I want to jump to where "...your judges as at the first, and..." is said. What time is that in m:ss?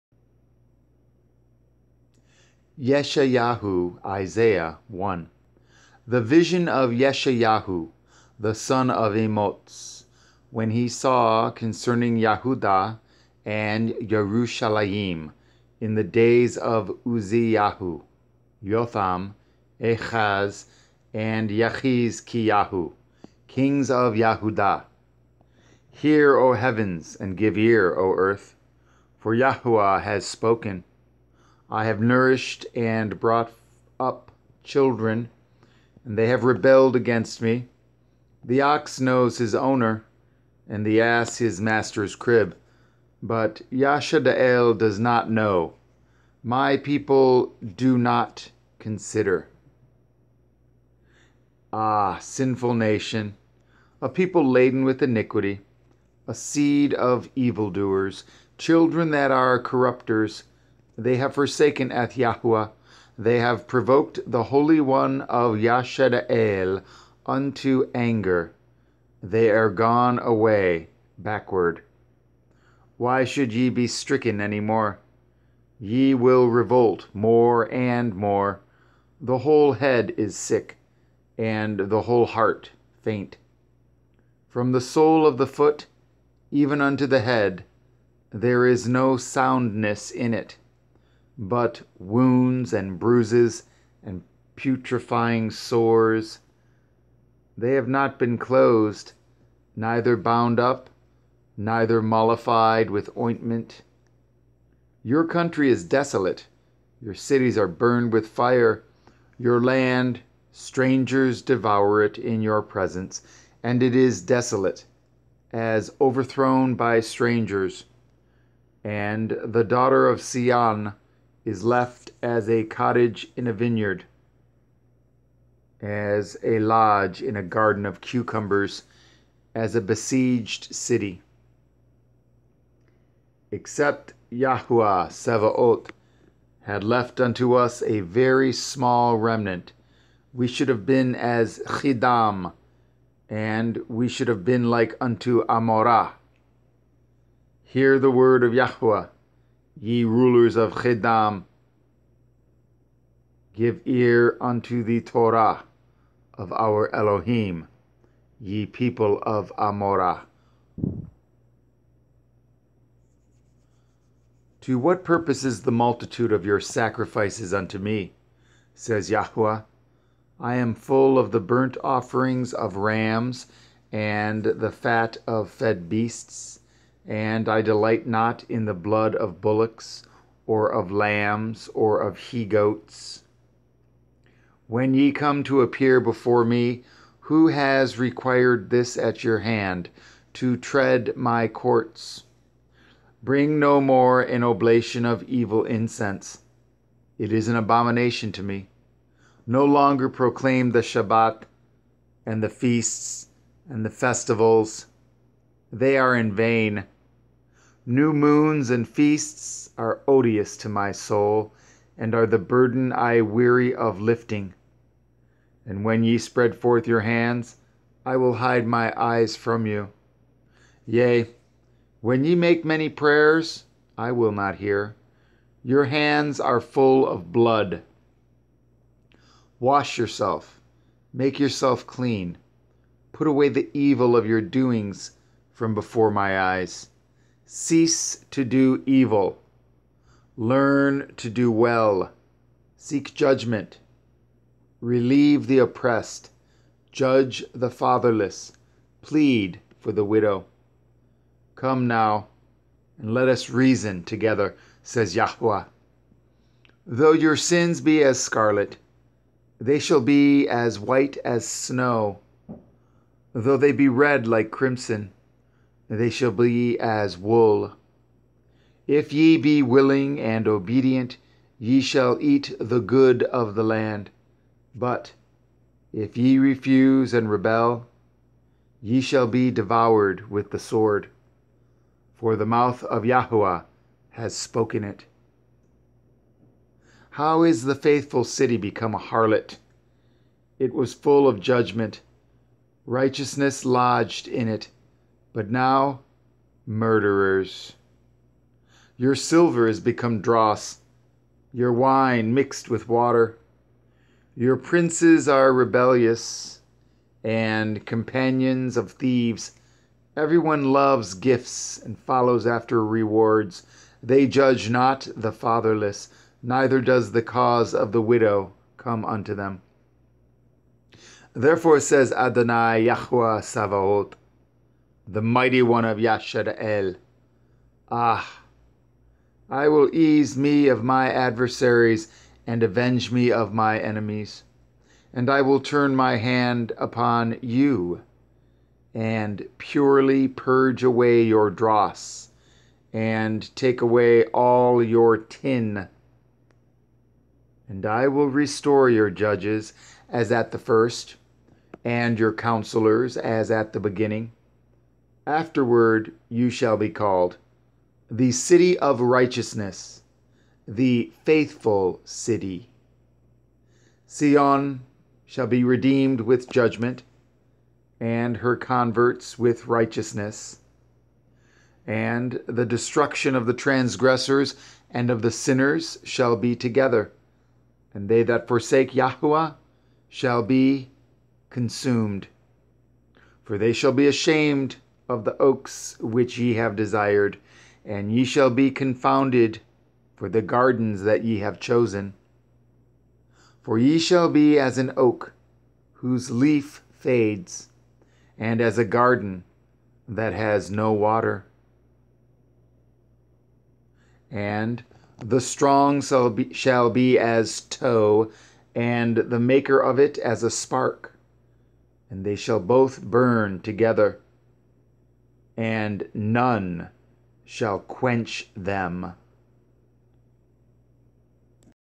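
5:48.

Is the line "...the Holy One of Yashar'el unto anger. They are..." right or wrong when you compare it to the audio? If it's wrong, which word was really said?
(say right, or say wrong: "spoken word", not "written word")
right.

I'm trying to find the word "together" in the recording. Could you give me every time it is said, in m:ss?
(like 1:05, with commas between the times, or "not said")
4:14, 6:16, 6:53.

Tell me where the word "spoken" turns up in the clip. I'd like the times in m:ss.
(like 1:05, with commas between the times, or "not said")
0:30, 4:44.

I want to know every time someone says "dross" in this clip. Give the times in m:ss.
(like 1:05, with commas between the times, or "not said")
5:00, 5:41.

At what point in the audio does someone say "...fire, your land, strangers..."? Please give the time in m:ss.
1:48.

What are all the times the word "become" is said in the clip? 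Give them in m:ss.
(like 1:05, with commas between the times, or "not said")
4:48, 4:59.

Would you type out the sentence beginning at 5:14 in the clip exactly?
They judge not the fatherless, neither does the cause of the widow come unto them.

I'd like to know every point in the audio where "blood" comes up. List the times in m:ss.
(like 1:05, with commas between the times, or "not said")
2:58, 3:47.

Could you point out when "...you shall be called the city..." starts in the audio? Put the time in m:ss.
5:56.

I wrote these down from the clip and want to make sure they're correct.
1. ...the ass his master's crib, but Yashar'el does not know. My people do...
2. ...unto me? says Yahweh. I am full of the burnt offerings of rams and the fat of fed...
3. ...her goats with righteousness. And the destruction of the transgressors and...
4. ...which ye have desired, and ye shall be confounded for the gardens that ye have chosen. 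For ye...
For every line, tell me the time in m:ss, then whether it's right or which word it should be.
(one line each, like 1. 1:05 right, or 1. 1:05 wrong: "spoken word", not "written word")
1. 0:40 right
2. 2:47 right
3. 6:08 wrong: "converts", not "goats"
4. 6:25 right.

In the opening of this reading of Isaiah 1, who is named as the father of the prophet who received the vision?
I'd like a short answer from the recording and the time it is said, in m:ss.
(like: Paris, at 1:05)
Emotz, at 0:09.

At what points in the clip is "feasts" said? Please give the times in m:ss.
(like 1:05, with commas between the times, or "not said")
3:22, 3:28.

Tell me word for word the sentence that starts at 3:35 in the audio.
And when ye spread forth your hands, I will hide my eyes from you.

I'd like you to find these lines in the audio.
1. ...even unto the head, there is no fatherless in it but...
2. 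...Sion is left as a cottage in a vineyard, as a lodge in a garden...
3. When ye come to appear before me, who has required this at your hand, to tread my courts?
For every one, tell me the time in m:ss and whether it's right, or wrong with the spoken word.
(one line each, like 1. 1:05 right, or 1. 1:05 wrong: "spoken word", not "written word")
1. 1:26 wrong: "soundness", not "fatherless"
2. 2:00 right
3. 3:04 right.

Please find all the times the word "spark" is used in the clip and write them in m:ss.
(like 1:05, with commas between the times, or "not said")
6:50.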